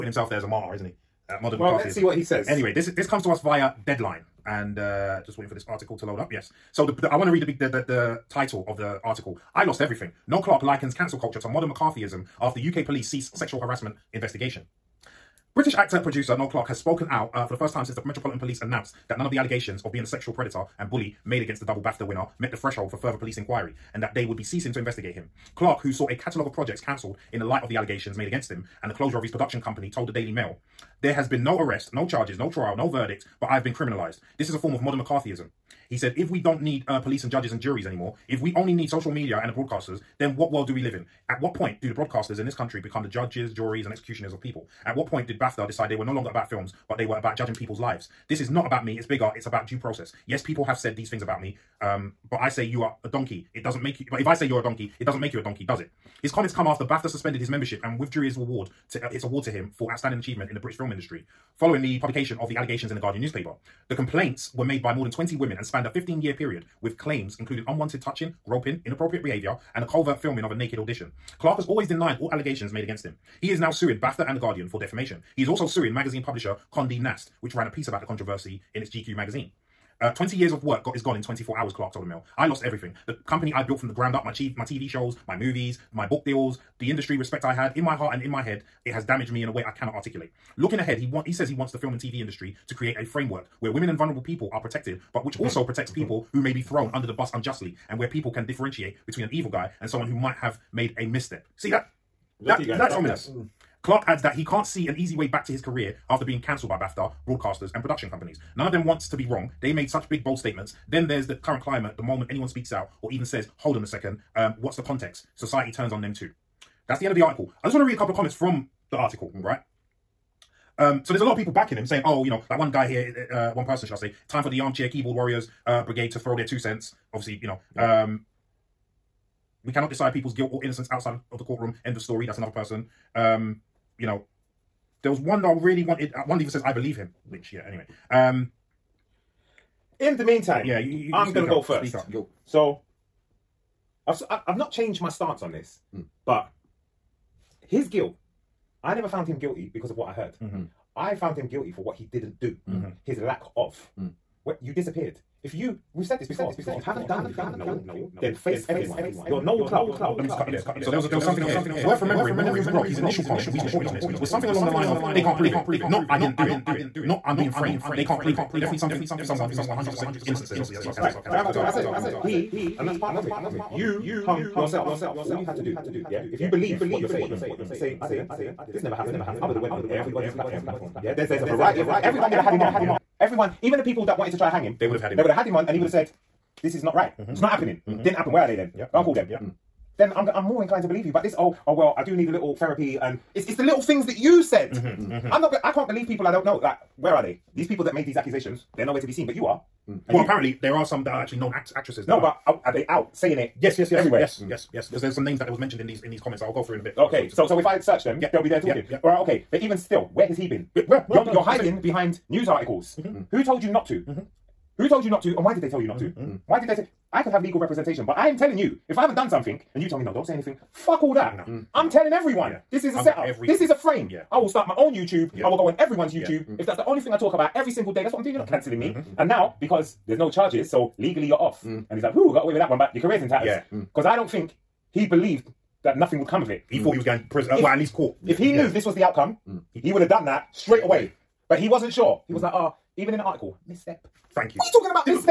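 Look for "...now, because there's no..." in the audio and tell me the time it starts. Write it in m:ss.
3:49.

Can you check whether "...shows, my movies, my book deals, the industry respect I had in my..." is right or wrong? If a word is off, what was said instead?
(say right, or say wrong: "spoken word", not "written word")
right.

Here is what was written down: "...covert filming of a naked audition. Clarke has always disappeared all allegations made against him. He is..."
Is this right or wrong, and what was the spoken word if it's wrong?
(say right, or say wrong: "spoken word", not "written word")
wrong: "denied", not "disappeared".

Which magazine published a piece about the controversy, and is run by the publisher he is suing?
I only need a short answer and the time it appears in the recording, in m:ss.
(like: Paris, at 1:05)
GQ, at 1:18.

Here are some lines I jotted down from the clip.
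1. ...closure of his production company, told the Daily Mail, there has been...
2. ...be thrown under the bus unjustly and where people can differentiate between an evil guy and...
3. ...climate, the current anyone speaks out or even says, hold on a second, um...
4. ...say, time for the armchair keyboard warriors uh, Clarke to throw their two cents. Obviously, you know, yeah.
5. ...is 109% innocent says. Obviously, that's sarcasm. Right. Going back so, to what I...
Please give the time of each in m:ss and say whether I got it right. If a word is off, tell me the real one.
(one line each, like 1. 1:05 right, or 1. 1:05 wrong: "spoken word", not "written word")
1. 0:28 right
2. 1:36 right
3. 1:51 wrong: "moment", not "current"
4. 2:03 wrong: "Brigade", not "Clarke"
5. 2:49 wrong: "100", not "109".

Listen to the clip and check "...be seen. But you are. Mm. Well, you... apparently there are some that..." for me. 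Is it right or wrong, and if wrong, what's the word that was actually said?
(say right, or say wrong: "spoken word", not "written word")
right.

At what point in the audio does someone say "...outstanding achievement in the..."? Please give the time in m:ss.
0:59.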